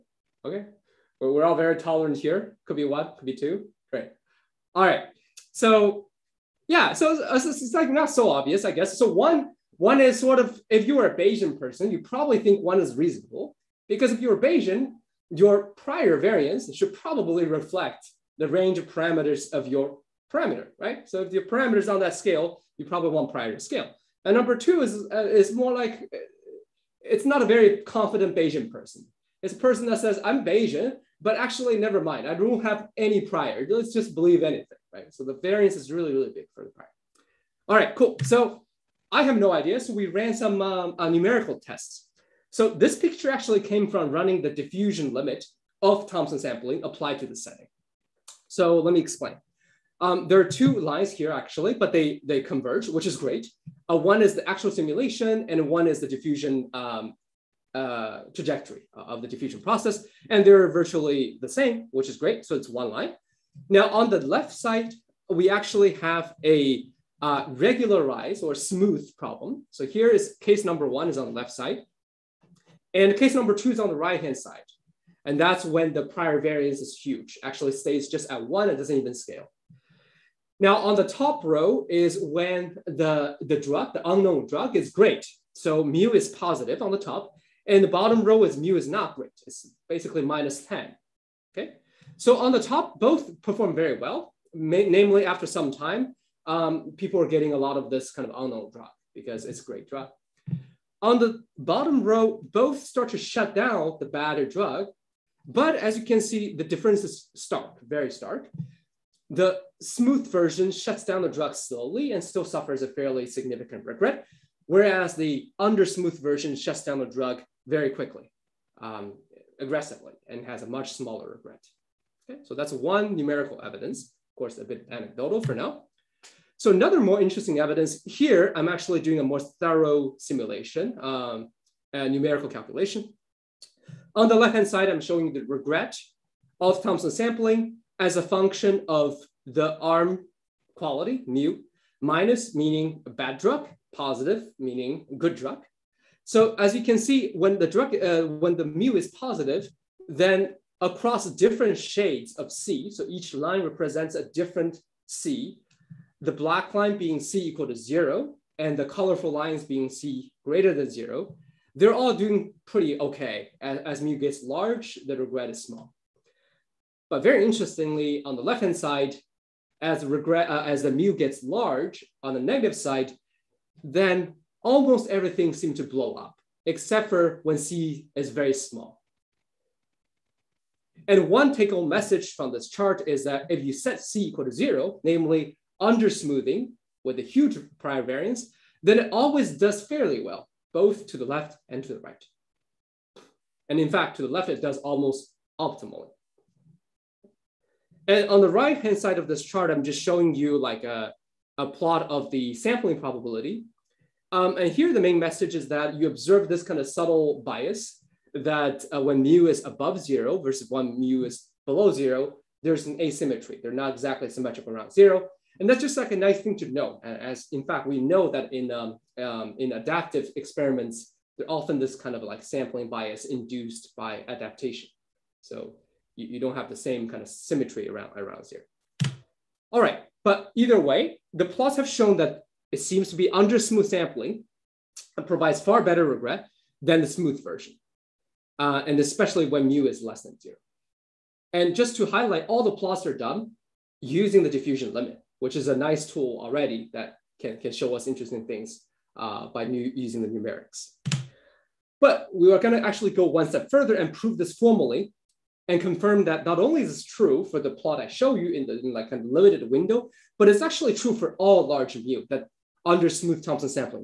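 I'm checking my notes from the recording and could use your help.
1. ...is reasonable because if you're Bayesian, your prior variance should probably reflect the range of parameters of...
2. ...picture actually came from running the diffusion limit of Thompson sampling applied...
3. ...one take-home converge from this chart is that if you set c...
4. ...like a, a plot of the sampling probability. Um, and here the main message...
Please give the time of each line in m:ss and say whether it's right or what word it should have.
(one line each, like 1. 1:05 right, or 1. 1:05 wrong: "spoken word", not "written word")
1. 0:12 right
2. 0:42 right
3. 3:01 wrong: "message", not "converge"
4. 3:20 right.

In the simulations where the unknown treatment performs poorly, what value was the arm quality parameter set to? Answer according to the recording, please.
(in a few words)
-10.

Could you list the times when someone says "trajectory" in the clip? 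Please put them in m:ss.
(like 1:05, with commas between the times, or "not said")
0:58.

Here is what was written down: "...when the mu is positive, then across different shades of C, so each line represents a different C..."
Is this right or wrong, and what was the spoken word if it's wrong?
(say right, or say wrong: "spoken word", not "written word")
right.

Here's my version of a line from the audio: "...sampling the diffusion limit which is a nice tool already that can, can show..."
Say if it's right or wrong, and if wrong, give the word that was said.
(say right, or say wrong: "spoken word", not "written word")
wrong: "using", not "sampling".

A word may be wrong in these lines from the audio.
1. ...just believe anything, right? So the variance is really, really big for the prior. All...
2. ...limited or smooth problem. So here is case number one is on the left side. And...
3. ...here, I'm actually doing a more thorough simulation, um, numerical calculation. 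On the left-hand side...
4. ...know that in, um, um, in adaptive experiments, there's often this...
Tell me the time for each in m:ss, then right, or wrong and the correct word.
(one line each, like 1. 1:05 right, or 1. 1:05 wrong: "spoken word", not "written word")
1. 0:33 right
2. 1:07 wrong: "regularized", not "limited"
3. 2:08 right
4. 3:37 right.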